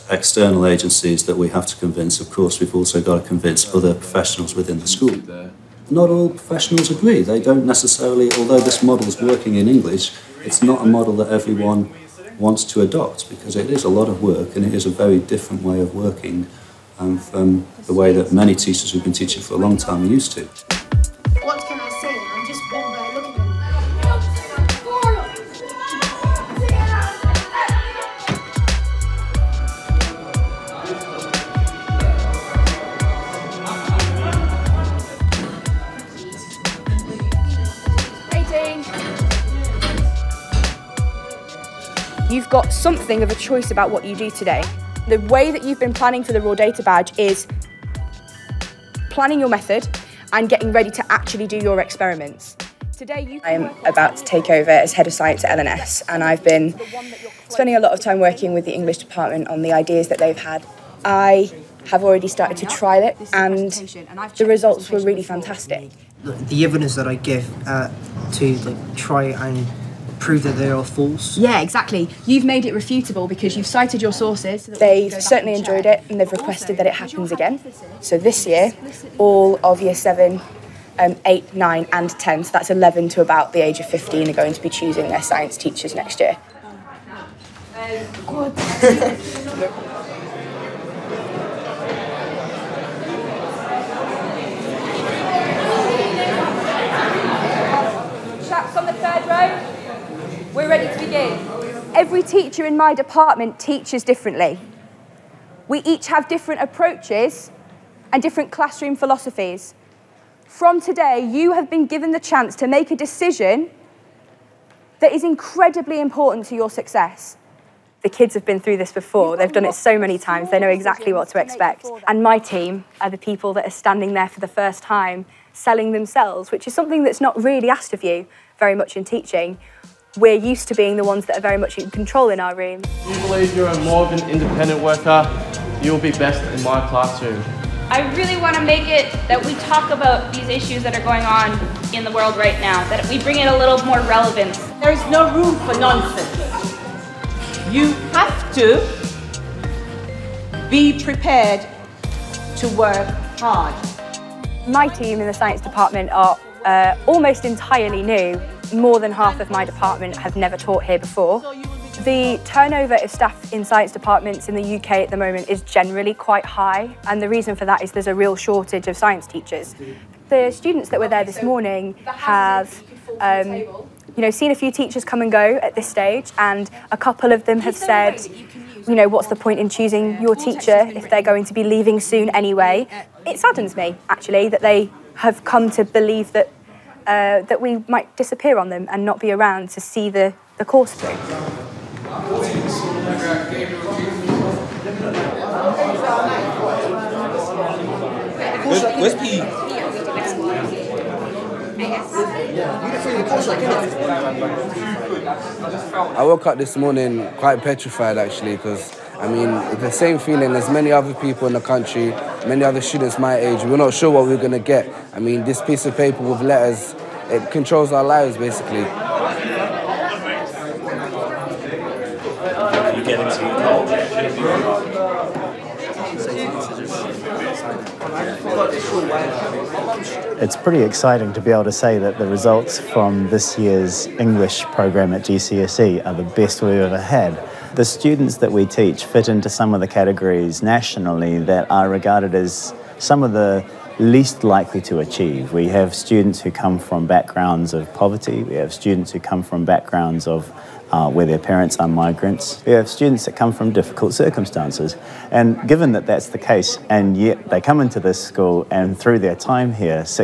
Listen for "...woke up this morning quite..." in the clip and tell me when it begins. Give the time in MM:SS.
03:26.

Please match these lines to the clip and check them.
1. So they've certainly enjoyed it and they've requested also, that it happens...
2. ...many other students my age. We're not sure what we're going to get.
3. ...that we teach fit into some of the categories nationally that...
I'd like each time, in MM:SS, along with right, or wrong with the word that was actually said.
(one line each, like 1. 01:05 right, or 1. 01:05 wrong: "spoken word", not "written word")
1. 01:14 right
2. 03:32 right
3. 03:58 right.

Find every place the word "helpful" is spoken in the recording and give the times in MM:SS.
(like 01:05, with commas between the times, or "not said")
not said.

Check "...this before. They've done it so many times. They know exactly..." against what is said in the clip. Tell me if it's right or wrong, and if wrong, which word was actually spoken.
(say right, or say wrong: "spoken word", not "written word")
right.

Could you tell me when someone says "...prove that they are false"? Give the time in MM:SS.
01:10.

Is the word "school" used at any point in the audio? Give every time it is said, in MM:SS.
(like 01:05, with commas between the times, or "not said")
00:04, 04:18.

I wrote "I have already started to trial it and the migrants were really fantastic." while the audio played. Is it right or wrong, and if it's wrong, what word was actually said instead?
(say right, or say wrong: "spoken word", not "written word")
wrong: "results", not "migrants".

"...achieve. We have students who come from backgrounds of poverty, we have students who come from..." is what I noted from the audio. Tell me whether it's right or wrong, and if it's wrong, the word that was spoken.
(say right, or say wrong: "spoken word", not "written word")
right.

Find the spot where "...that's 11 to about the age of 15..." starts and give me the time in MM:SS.
01:22.